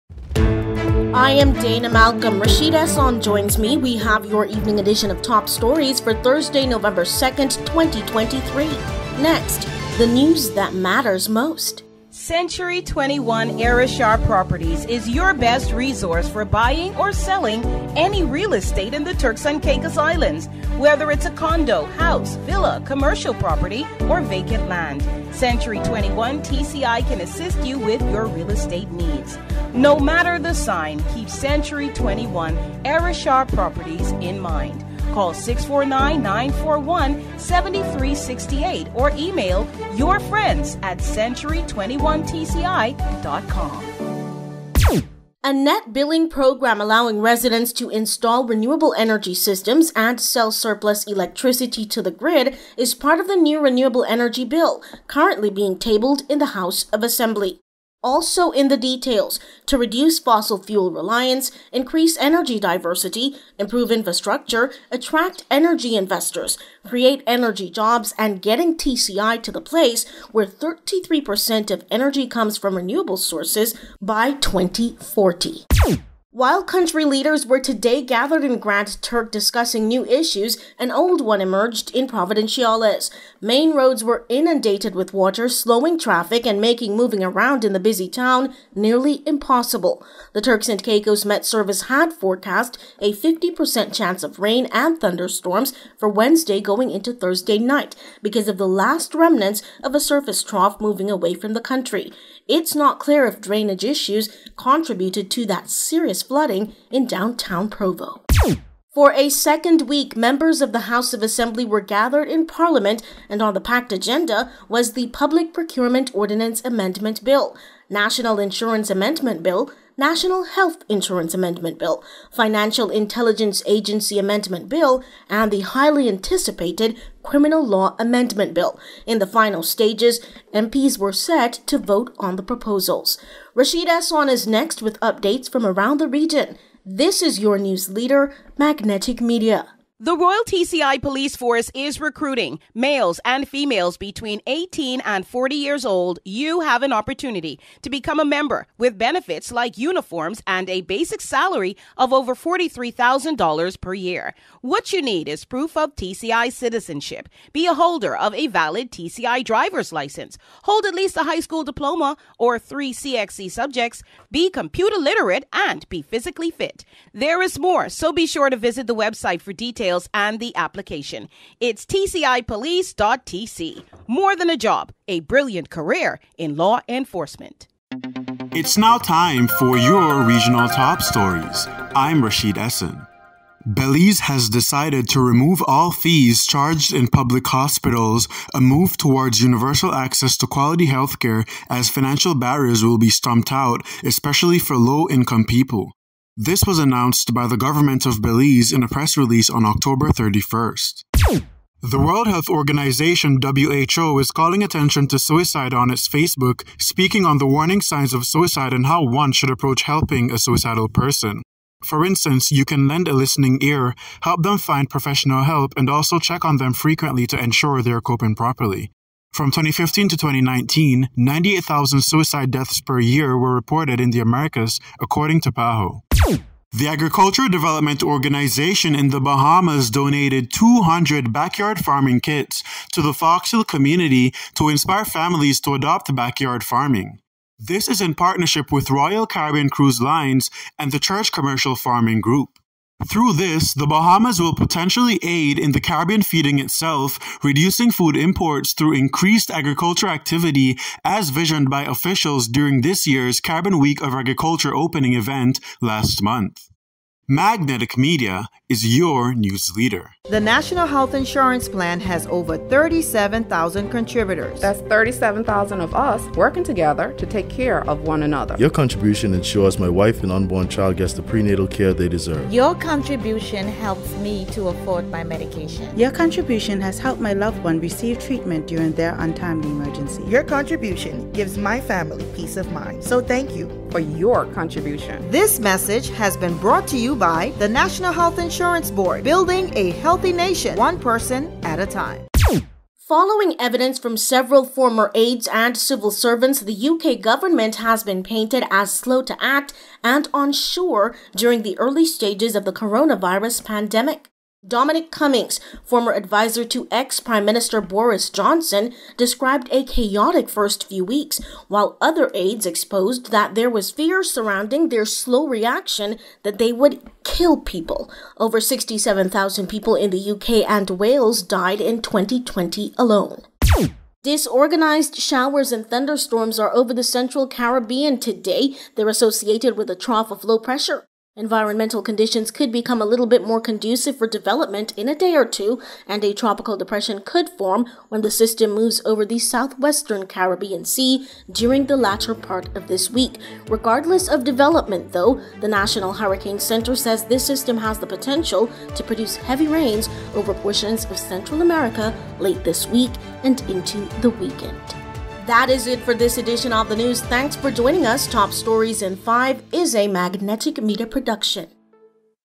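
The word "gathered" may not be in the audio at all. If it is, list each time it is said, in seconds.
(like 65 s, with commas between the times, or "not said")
78 s, 111 s.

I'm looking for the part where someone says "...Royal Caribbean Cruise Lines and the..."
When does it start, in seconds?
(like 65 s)
238 s.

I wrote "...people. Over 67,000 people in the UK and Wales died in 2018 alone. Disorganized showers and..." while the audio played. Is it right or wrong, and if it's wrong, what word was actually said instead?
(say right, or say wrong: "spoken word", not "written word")
wrong: "2020", not "2018".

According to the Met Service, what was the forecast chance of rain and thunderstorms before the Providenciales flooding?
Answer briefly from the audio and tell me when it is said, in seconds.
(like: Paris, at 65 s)
50%, at 93 s.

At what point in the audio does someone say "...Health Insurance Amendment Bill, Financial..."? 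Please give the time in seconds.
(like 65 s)
120 s.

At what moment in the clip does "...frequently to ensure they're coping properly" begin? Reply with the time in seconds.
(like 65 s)
216 s.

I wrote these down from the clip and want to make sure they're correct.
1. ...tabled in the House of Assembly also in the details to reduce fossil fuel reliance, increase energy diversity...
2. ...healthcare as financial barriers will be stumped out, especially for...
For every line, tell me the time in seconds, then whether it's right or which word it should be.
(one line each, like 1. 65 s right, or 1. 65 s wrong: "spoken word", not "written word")
1. 55 s right
2. 190 s right.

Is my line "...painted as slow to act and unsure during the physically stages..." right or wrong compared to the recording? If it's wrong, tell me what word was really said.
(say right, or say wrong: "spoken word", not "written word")
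wrong: "early", not "physically".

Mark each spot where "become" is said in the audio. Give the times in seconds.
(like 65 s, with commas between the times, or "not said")
147 s, 332 s.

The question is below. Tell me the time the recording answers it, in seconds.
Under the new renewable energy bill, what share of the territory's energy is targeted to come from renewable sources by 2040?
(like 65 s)
70 s.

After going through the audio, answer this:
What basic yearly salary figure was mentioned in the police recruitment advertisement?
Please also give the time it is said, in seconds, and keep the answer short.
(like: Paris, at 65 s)
Over $43,000, at 152 s.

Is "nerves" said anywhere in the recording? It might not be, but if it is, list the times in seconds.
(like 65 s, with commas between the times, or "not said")
not said.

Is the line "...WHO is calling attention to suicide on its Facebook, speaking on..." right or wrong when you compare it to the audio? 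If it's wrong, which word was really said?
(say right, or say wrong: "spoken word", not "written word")
right.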